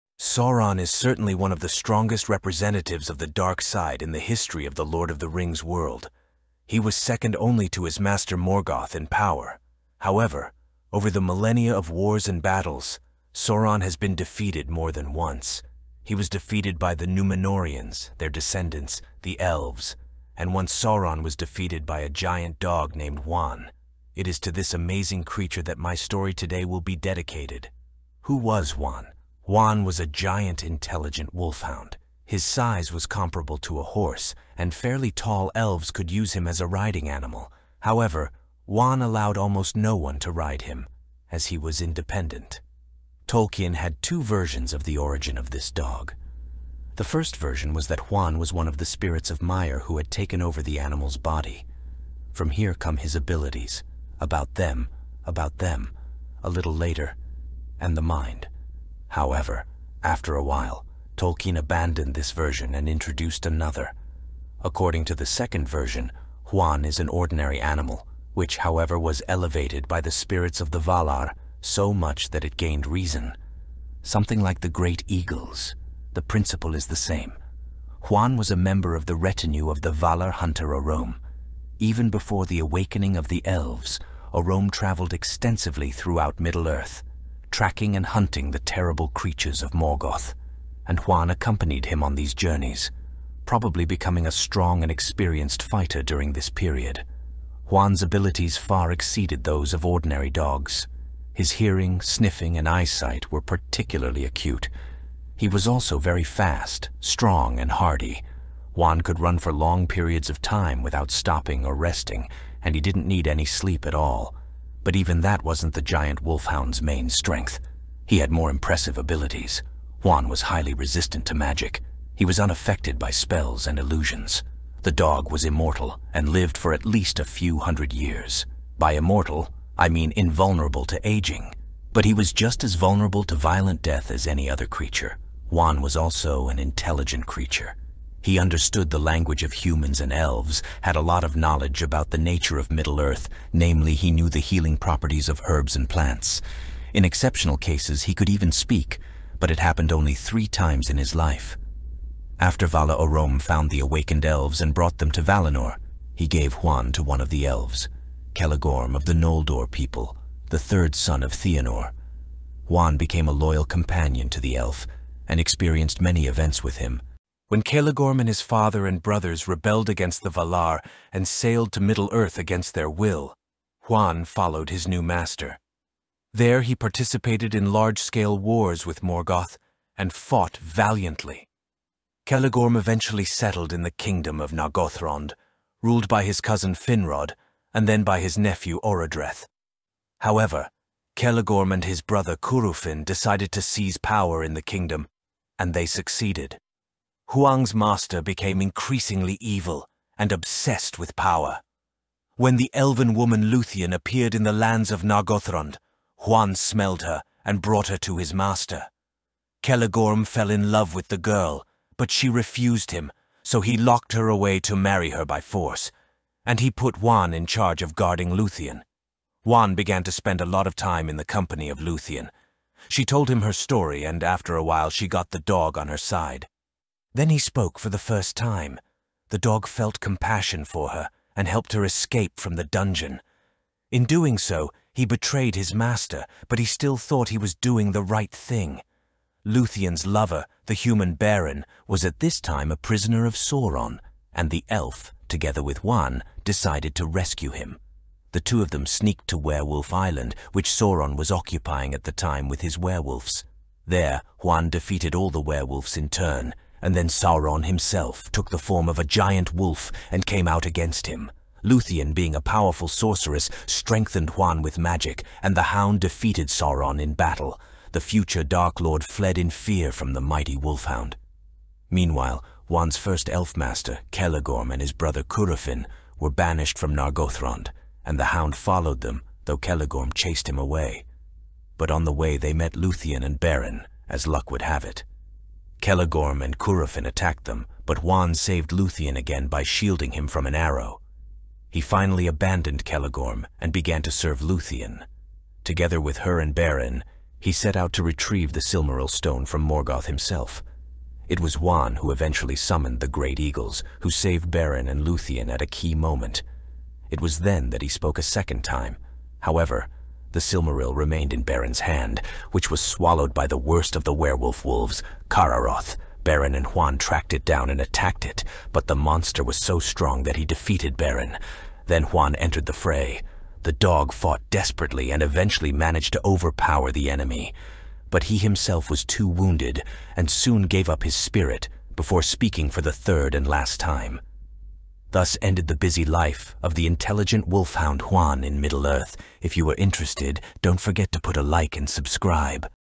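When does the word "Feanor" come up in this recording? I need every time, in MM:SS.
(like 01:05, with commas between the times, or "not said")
02:41.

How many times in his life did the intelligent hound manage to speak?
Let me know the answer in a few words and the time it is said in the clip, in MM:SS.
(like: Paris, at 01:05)
3, at 02:30.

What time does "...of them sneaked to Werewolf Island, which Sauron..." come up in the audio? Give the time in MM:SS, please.
04:08.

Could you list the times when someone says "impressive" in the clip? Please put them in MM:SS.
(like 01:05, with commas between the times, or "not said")
01:58.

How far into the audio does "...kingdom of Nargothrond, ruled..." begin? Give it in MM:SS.
03:03.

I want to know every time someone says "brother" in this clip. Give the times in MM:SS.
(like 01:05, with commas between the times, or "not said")
02:49, 03:12, 04:34.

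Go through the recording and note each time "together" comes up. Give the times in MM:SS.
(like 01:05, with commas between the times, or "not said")
04:05, 04:55.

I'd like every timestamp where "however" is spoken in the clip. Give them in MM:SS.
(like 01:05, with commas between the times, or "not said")
00:10, 00:37, 00:59, 01:08, 03:10, 05:09.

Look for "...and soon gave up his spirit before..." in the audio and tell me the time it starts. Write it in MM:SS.
05:30.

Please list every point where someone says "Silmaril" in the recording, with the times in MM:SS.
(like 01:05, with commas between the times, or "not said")
04:58, 05:10.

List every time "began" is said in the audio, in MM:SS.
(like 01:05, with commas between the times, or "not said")
03:39, 04:53.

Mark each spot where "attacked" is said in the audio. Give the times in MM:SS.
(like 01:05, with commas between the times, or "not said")
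04:47, 05:17.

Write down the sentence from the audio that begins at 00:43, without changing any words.
Tolkien had two versions of the origin of this dog.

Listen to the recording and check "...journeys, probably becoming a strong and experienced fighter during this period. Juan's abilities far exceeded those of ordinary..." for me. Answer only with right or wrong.
right.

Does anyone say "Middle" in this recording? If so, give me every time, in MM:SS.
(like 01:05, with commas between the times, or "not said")
01:26, 02:22, 02:51, 05:38.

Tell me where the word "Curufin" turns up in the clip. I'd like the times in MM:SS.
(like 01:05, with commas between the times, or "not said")
03:12, 04:35, 04:46.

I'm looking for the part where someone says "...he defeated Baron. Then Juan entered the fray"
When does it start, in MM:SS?
05:20.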